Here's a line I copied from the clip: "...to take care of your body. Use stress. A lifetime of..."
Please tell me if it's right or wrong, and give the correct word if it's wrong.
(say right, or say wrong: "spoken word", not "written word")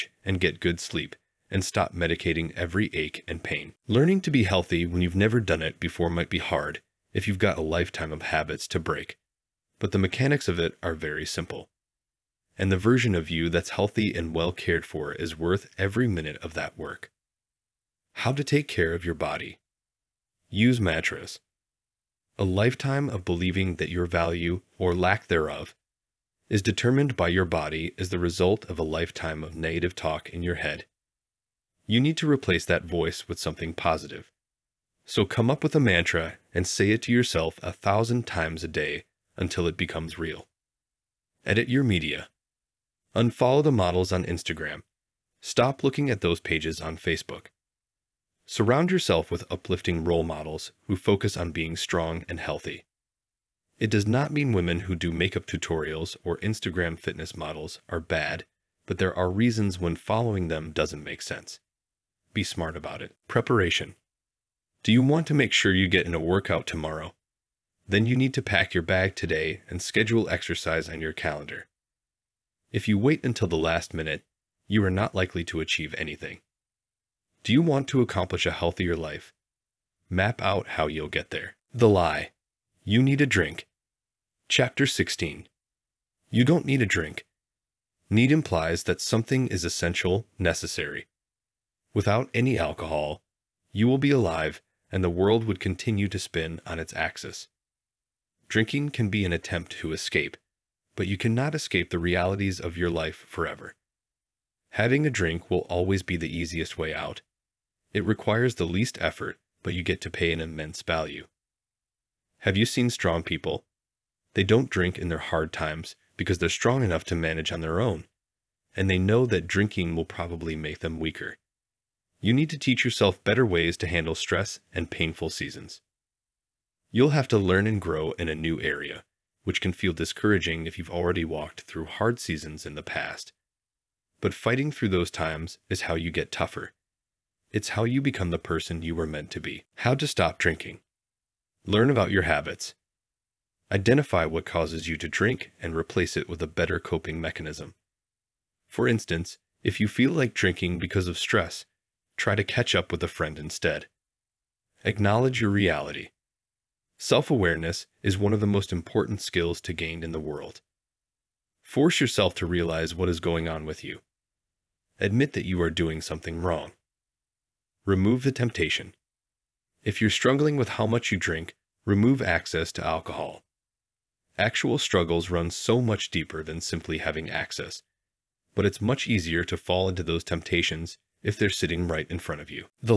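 wrong: "mattress", not "stress".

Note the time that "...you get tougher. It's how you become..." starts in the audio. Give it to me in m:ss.
2:15.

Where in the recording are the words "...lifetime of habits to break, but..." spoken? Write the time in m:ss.
0:07.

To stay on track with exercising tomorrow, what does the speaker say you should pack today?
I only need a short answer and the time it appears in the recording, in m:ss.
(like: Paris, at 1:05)
your bag, at 1:08.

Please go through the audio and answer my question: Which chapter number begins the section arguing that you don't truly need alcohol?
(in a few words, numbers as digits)
16.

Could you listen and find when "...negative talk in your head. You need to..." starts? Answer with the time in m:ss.
0:29.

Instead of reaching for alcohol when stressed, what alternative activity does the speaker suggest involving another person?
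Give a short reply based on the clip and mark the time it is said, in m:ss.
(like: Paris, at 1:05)
catch up with a friend, at 2:32.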